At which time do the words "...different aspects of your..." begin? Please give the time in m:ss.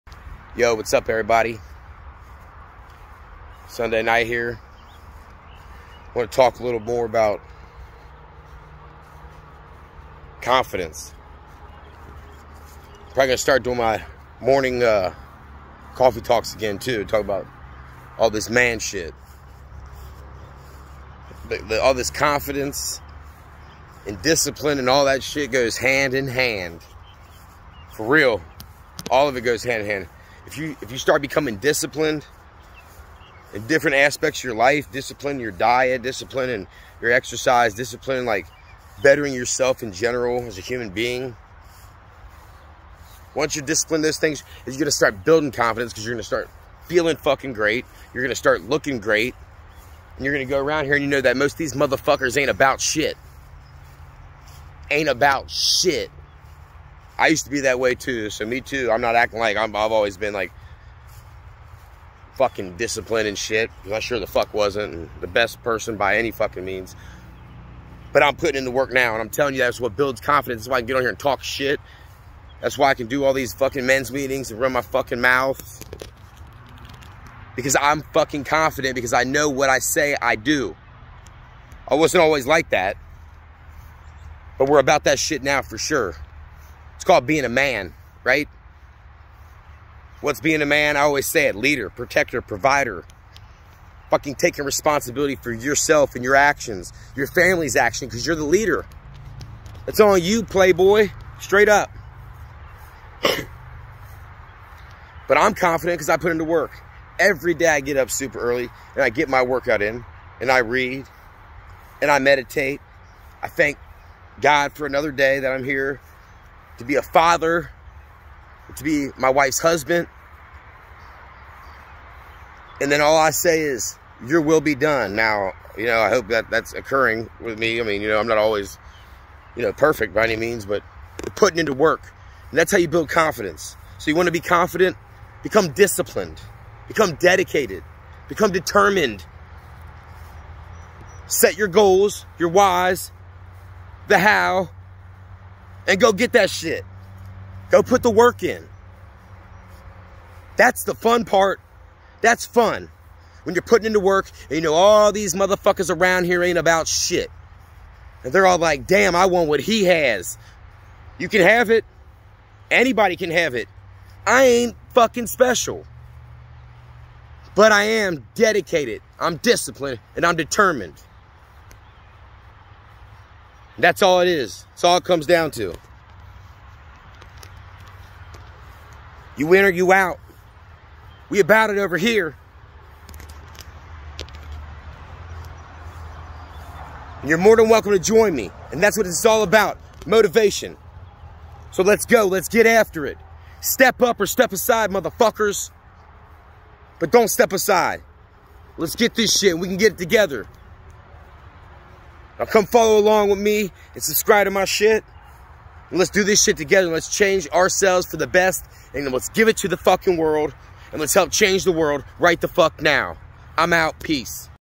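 0:33.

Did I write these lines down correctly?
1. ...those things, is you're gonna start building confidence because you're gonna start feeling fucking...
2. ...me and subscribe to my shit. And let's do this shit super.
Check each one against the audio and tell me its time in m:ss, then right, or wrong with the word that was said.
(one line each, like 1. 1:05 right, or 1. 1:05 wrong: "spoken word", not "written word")
1. 0:44 right
2. 3:23 wrong: "together", not "super".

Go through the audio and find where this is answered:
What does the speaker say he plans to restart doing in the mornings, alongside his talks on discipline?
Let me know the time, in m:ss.
0:15.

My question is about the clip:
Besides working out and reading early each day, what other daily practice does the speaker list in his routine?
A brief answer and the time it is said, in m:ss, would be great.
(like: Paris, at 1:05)
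meditate, at 1:52.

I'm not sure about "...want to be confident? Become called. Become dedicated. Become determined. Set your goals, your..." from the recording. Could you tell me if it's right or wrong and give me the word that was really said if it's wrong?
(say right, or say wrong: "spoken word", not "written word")
wrong: "disciplined", not "called".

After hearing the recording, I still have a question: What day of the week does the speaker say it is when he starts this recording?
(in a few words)
Sunday.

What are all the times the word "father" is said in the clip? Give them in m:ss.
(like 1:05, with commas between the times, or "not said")
1:57.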